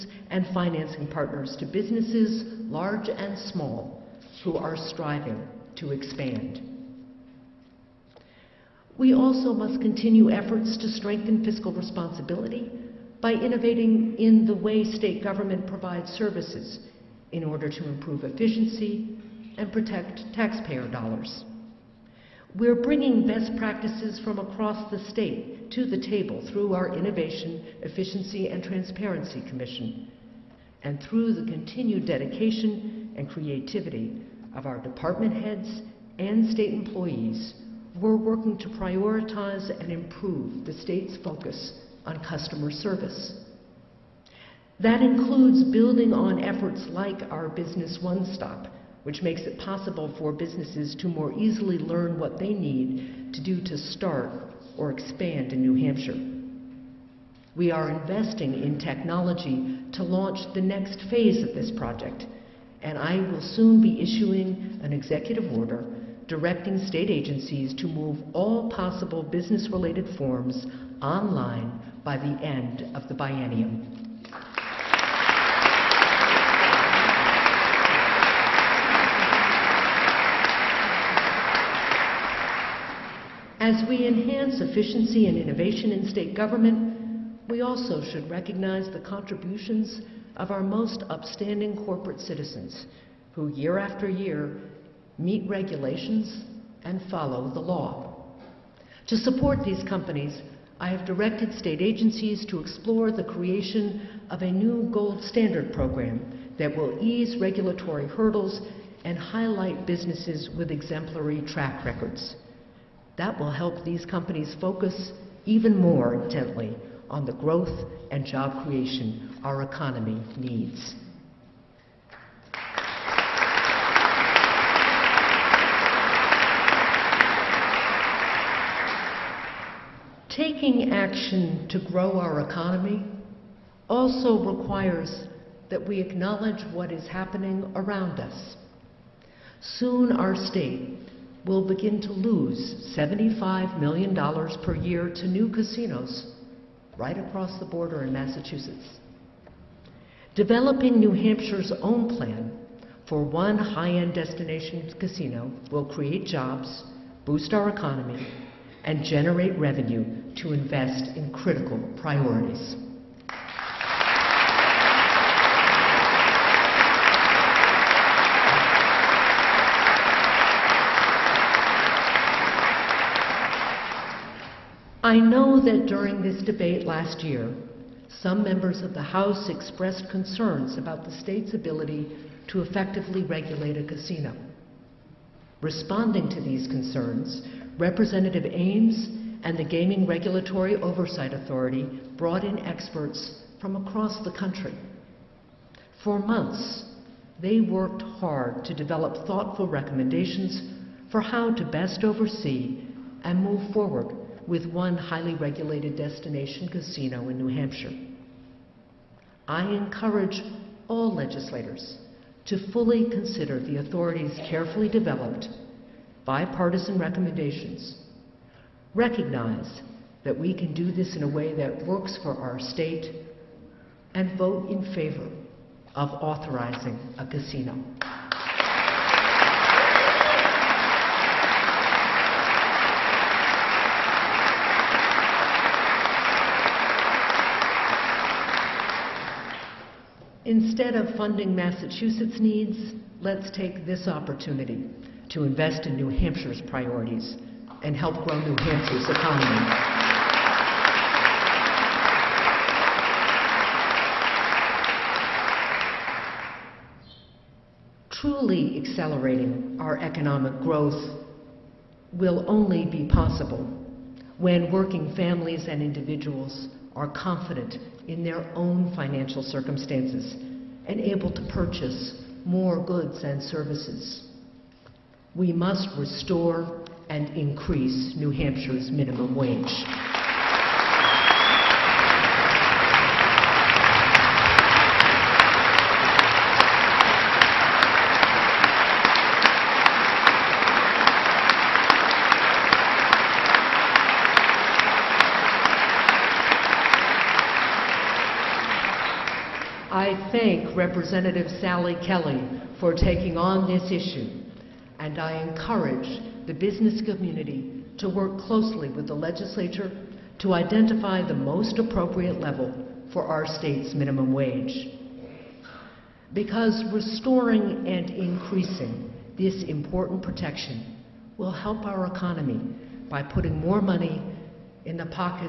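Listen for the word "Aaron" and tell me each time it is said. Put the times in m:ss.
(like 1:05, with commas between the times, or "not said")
not said.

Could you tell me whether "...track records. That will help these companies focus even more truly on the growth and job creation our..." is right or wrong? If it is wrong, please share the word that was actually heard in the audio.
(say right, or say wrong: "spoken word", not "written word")
wrong: "intently", not "truly".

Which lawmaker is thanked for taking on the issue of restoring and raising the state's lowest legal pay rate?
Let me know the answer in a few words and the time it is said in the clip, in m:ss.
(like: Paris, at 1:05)
Sally Kelly, at 5:01.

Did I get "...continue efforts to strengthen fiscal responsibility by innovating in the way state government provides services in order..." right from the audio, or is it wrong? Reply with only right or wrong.
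right.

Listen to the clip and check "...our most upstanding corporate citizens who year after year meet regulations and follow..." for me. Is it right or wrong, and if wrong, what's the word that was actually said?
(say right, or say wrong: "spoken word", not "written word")
right.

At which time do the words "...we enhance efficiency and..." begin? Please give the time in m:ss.
1:23.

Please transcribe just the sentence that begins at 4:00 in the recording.
Instead of funding Massachusetts' needs, let's take this opportunity to invest in New Hampshire's priorities and help grow New Hampshire's economy.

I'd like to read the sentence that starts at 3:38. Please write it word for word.
Recognize that we can do this in a way that works for our state and vote in favor of authorizing a casino.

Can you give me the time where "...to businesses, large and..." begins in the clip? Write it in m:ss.
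0:01.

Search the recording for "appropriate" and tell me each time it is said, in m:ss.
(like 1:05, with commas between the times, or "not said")
5:11.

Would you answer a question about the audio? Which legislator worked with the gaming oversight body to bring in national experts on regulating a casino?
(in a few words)
Representative Ames.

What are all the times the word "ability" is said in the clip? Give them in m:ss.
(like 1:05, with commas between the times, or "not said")
3:01.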